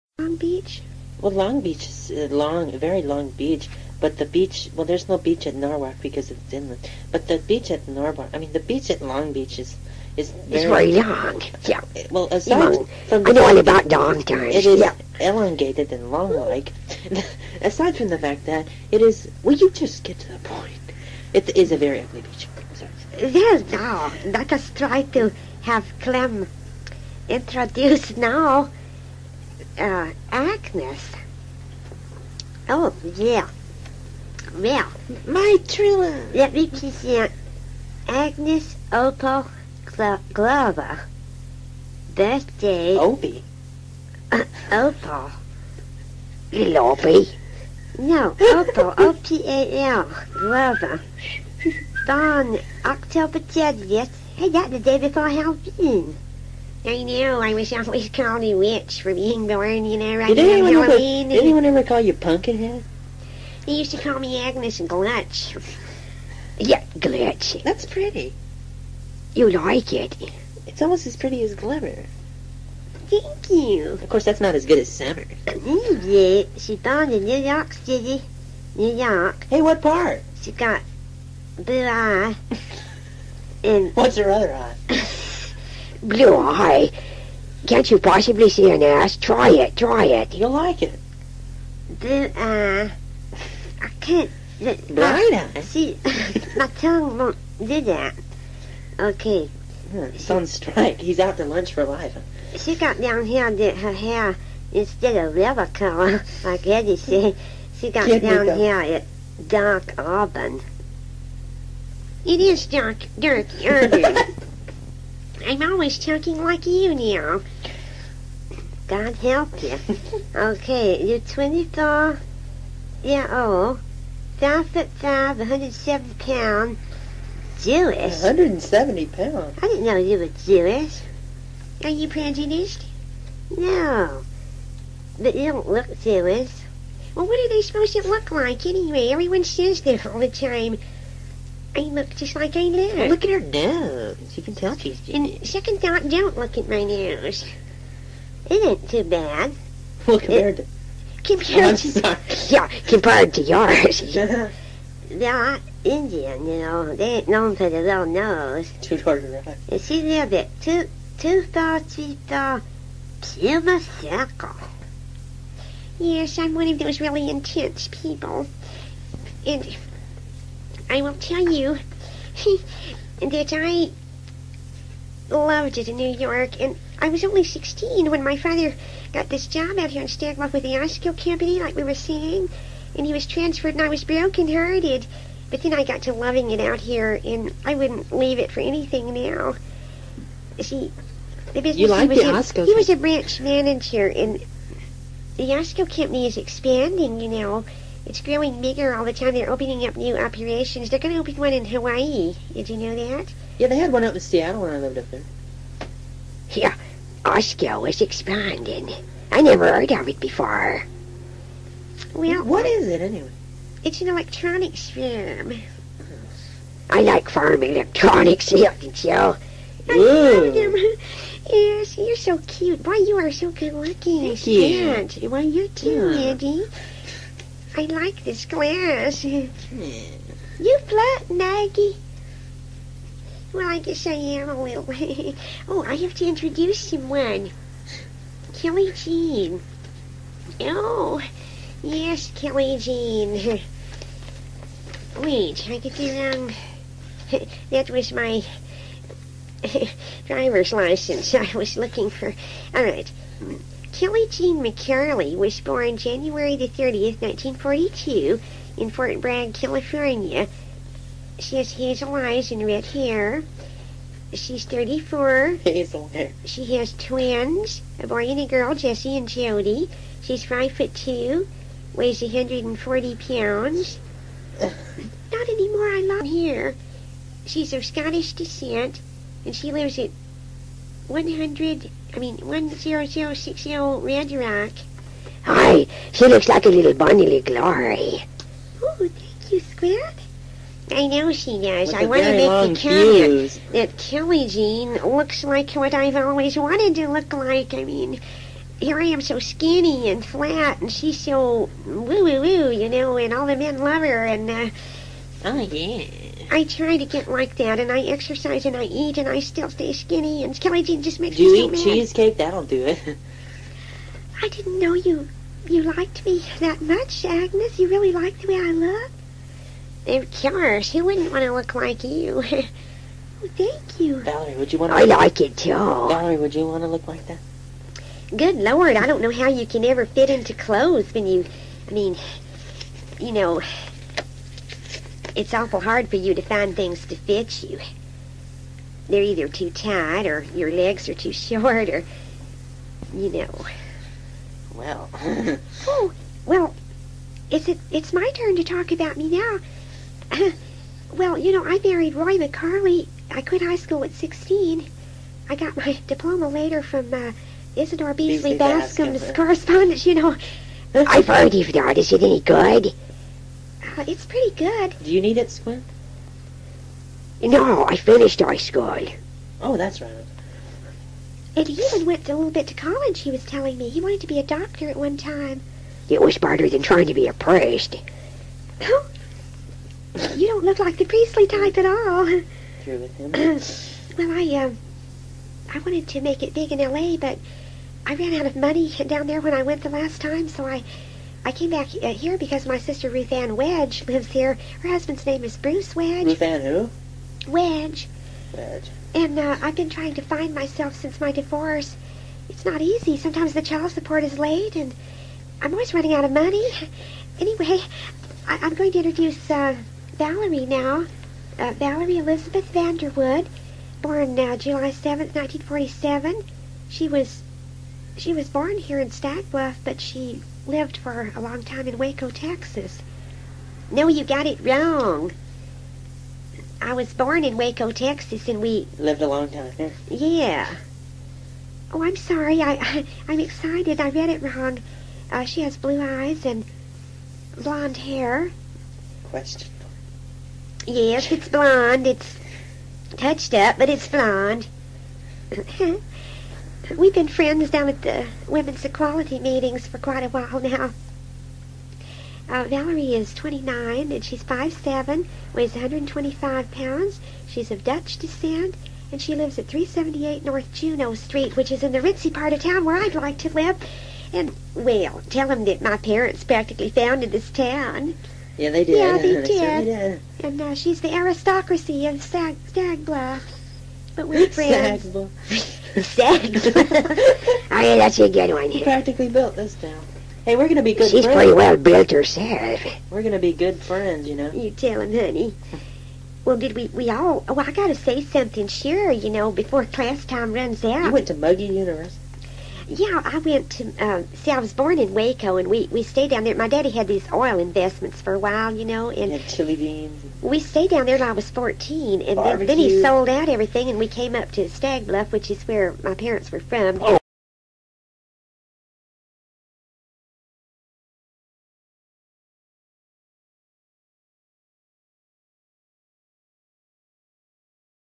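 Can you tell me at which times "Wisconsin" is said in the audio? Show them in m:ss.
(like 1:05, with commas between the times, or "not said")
not said.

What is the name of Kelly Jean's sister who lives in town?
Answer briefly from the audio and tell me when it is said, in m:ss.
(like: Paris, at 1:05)
Ruth Ann Wedge, at 6:33.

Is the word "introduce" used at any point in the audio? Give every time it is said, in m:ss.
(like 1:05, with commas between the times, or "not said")
0:27, 3:56, 6:48.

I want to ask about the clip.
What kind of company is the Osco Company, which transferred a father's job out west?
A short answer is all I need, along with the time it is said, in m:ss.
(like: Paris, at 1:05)
Electronics firm, at 3:34.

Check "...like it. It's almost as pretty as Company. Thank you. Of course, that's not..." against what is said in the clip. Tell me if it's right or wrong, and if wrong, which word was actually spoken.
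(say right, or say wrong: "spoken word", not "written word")
wrong: "Glimmer", not "Company".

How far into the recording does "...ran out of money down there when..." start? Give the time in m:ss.
6:28.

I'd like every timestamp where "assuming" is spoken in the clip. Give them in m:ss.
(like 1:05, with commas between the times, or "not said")
not said.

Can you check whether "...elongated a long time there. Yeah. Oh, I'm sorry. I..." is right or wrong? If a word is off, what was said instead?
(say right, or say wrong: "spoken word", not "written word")
wrong: "lived", not "elongated".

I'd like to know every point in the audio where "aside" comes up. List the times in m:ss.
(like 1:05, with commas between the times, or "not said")
0:12, 0:17.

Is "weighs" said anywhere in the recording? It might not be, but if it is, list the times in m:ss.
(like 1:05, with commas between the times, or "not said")
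4:31, 7:35.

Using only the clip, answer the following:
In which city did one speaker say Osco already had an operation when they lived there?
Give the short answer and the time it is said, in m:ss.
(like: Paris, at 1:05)
Seattle, at 3:24.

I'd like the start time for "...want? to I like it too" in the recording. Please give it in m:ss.
5:24.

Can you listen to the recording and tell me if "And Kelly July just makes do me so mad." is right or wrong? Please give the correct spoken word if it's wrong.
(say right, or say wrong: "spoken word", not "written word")
wrong: "Jean", not "July".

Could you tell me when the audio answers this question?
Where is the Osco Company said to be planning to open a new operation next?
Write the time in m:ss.
3:21.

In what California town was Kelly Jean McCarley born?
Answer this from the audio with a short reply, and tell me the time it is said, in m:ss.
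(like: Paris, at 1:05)
Fort Bragg, at 4:18.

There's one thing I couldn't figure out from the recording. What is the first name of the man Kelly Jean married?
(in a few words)
Roy.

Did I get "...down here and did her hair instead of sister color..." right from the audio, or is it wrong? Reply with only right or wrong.
wrong.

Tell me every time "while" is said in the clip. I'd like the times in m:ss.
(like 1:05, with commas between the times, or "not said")
7:30, 8:18.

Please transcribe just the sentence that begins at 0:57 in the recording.
I was always called a witch for being born, you know, right did anyone ever, Did anyone ever call you Pumpkinhead?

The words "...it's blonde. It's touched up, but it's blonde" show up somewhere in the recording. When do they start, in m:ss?
7:21.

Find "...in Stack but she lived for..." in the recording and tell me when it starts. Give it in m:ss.
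6:58.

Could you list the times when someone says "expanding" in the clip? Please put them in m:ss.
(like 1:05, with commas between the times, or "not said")
3:16, 3:28.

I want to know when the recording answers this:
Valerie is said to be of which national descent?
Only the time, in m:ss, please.
7:37.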